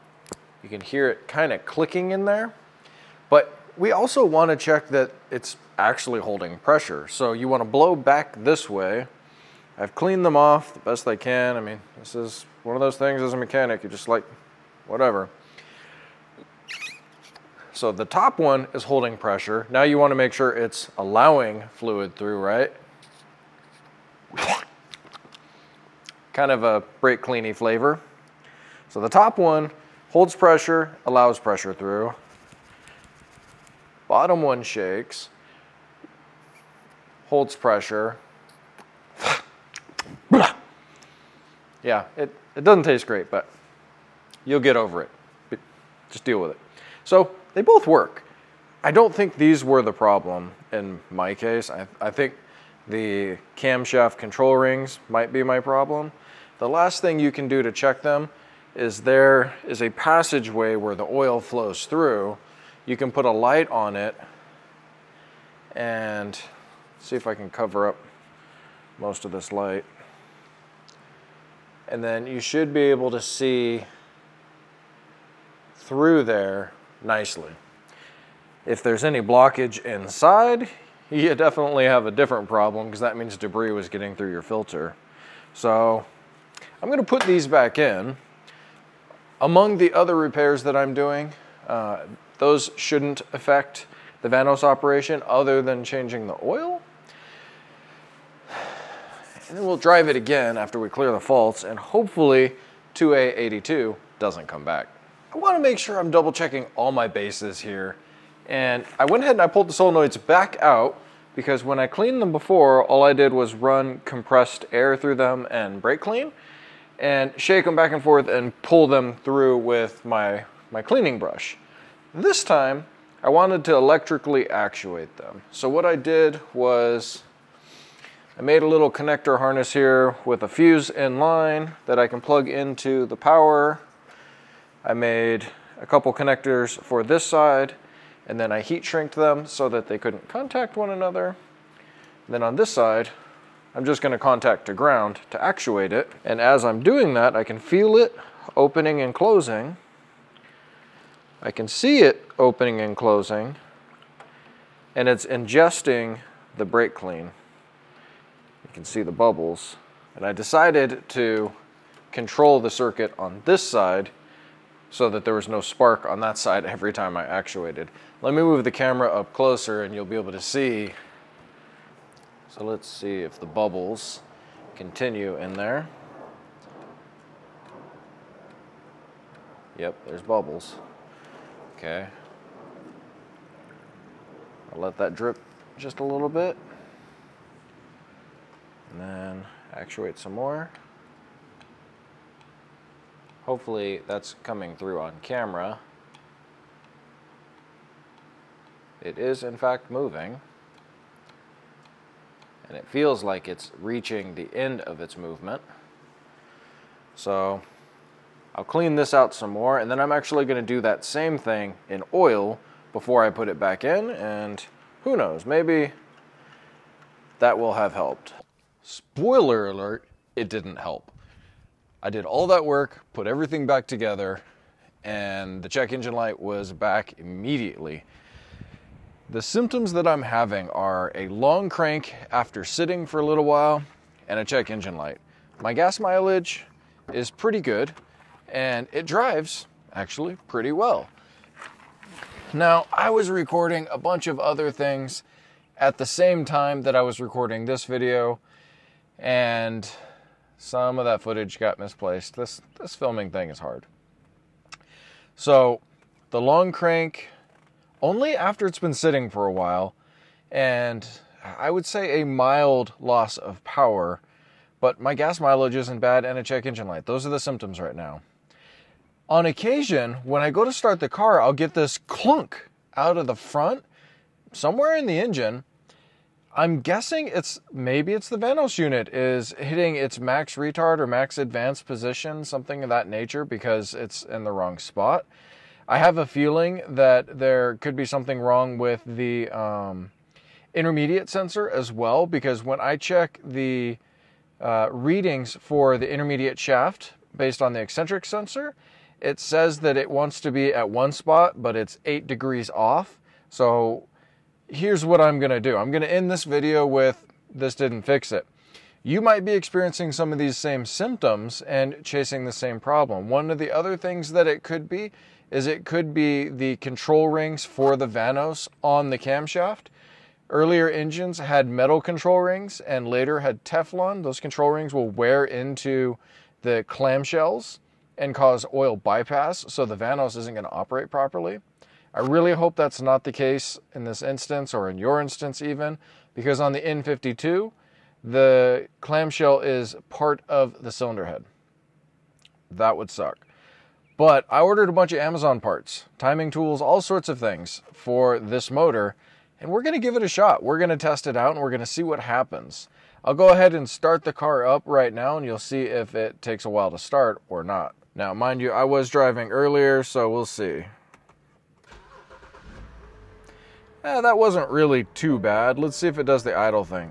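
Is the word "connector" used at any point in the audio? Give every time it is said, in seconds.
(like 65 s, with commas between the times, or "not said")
128 s, 136 s.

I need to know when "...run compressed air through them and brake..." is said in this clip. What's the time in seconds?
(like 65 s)
113 s.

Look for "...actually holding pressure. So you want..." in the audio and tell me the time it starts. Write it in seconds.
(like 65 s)
5 s.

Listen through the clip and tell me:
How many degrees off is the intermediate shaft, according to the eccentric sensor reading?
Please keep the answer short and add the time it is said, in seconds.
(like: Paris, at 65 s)
8, at 302 s.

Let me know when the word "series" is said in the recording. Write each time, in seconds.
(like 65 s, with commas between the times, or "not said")
not said.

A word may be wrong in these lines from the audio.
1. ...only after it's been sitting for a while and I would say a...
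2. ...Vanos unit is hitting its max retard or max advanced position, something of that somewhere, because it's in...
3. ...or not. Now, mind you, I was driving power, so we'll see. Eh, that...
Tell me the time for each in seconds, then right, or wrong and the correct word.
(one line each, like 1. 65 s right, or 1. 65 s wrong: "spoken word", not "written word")
1. 258 s right
2. 278 s wrong: "nature", not "somewhere"
3. 357 s wrong: "earlier", not "power".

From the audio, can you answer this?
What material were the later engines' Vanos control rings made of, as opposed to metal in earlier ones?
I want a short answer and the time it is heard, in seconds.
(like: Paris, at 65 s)
Teflon, at 323 s.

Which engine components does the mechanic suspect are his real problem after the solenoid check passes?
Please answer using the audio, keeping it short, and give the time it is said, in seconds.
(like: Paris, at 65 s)
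camshaft control rings, at 53 s.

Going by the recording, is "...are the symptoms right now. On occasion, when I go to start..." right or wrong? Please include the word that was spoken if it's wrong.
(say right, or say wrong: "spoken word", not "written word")
right.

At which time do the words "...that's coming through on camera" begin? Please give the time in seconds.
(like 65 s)
194 s.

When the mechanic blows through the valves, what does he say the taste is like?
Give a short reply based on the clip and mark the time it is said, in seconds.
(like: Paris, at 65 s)
brake cleany, at 26 s.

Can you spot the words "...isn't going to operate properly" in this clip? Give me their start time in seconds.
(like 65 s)
330 s.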